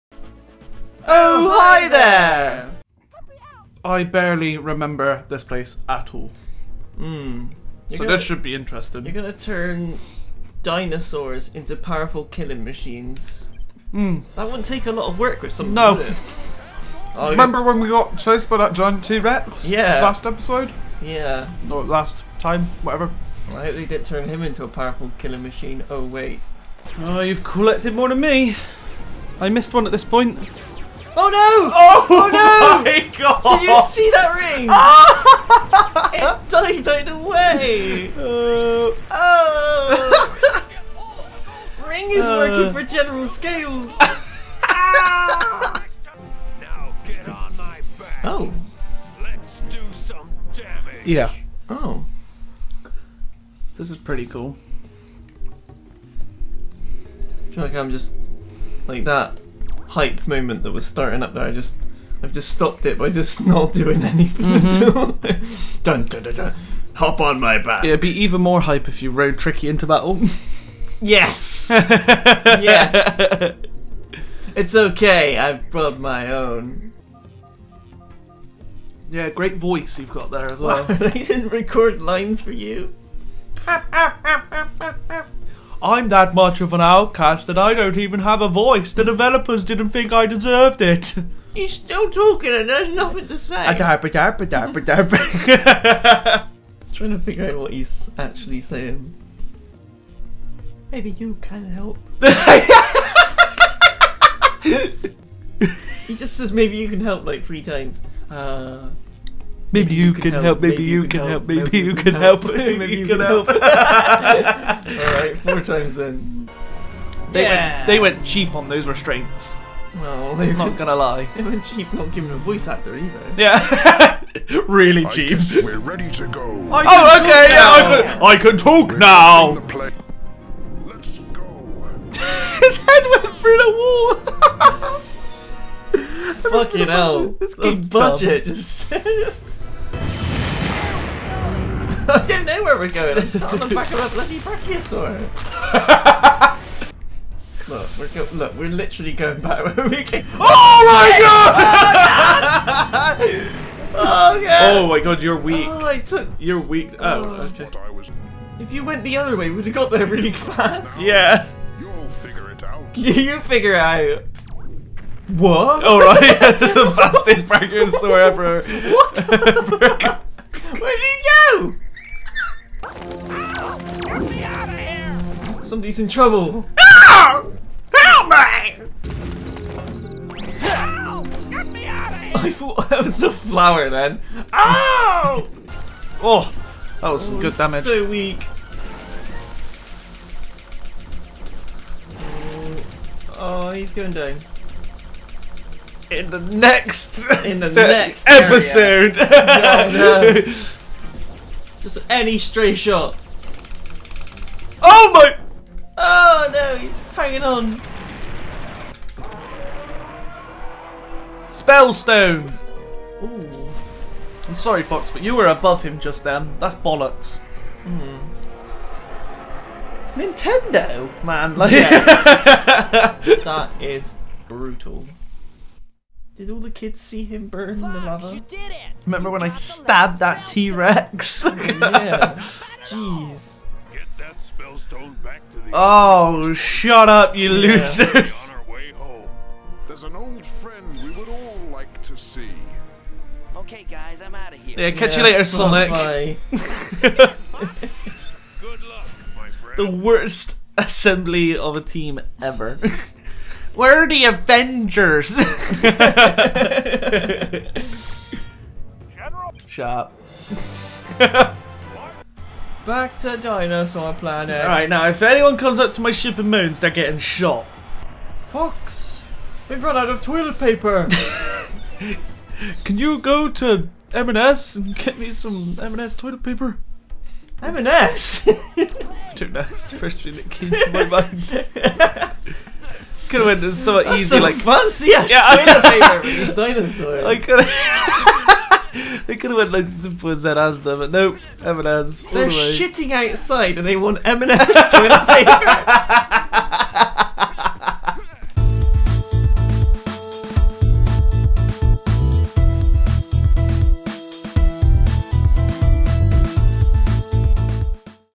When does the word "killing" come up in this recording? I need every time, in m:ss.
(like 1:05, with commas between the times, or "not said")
0:12, 0:25.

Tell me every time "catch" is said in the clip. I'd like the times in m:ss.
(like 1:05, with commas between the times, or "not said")
4:04.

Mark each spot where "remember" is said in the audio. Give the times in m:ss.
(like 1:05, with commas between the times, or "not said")
0:04, 0:17, 3:49.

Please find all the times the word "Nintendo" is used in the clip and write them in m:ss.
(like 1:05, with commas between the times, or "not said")
3:40.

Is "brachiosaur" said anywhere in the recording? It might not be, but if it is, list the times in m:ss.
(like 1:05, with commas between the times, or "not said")
2:24, 2:47.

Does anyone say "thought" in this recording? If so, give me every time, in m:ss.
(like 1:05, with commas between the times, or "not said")
3:02.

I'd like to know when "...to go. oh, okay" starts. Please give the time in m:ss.
2:06.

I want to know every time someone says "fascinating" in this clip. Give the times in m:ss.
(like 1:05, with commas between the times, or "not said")
not said.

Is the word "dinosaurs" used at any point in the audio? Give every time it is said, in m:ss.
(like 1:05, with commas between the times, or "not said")
0:10, 4:23, 4:46.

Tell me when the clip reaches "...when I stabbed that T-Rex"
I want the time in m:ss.
3:49.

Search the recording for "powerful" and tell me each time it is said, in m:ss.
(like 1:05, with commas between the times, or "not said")
0:11, 0:24.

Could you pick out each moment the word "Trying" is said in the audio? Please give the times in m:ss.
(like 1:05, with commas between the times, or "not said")
1:33.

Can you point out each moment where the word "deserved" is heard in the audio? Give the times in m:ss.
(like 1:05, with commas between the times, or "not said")
1:30.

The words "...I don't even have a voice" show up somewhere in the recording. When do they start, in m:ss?
1:27.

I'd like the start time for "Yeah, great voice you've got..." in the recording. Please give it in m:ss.
1:19.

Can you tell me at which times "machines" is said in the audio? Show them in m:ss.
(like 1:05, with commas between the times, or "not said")
0:12, 0:25.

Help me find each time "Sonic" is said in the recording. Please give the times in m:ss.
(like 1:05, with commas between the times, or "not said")
4:05.